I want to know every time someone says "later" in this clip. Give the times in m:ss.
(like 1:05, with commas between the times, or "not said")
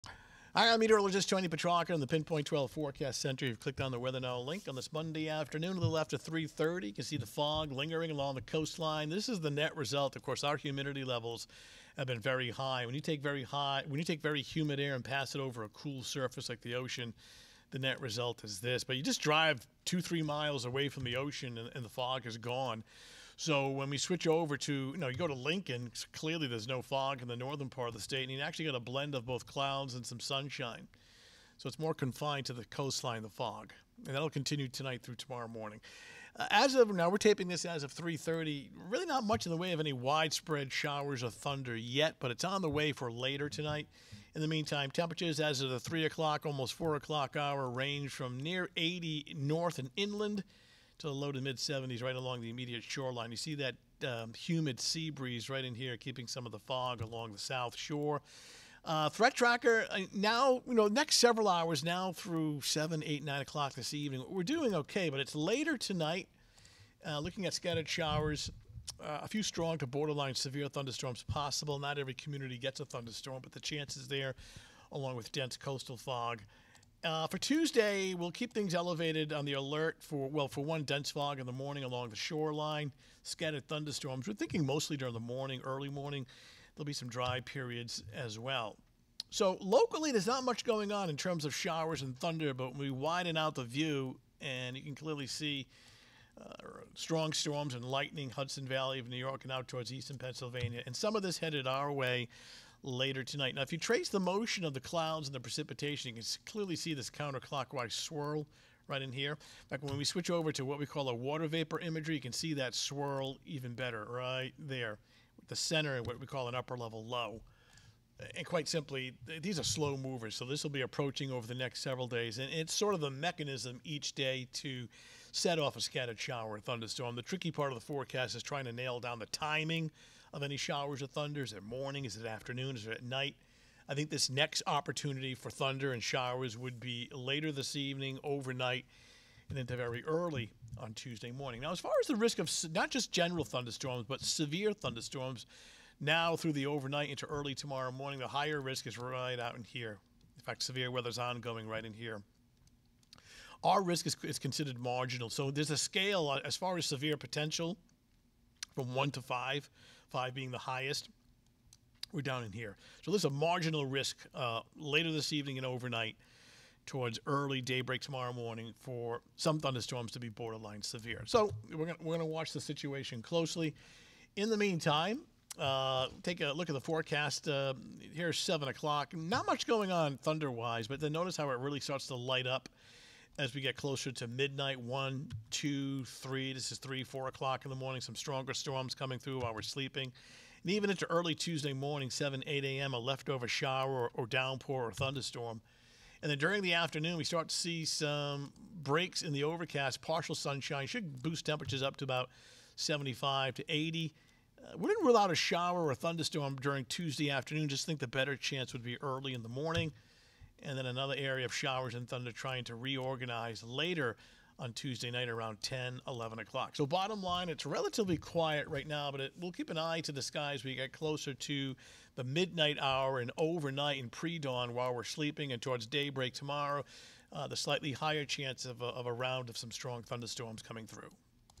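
0:43, 1:05, 1:42, 2:17, 2:44, 3:33.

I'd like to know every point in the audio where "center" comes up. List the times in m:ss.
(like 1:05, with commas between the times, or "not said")
0:03, 1:55.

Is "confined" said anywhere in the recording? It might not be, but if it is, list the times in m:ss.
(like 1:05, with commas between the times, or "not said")
0:31.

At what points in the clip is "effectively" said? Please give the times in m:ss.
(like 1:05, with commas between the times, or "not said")
not said.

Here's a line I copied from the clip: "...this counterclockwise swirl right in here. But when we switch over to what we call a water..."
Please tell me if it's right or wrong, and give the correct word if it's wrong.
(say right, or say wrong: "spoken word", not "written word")
right.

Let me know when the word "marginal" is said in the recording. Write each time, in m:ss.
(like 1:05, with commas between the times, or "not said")
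2:34, 2:43.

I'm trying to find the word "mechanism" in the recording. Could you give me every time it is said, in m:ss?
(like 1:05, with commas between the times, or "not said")
2:03.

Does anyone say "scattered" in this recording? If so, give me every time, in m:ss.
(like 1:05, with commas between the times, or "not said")
1:07, 1:23, 2:05.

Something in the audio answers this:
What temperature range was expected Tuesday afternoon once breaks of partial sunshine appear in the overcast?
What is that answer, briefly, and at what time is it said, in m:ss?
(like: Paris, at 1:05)
75 to 80, at 3:22.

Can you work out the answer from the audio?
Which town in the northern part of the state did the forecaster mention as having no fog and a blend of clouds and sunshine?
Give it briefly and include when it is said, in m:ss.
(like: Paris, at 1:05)
Lincoln, at 0:25.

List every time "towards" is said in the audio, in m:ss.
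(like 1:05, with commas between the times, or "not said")
1:39, 2:46, 3:45.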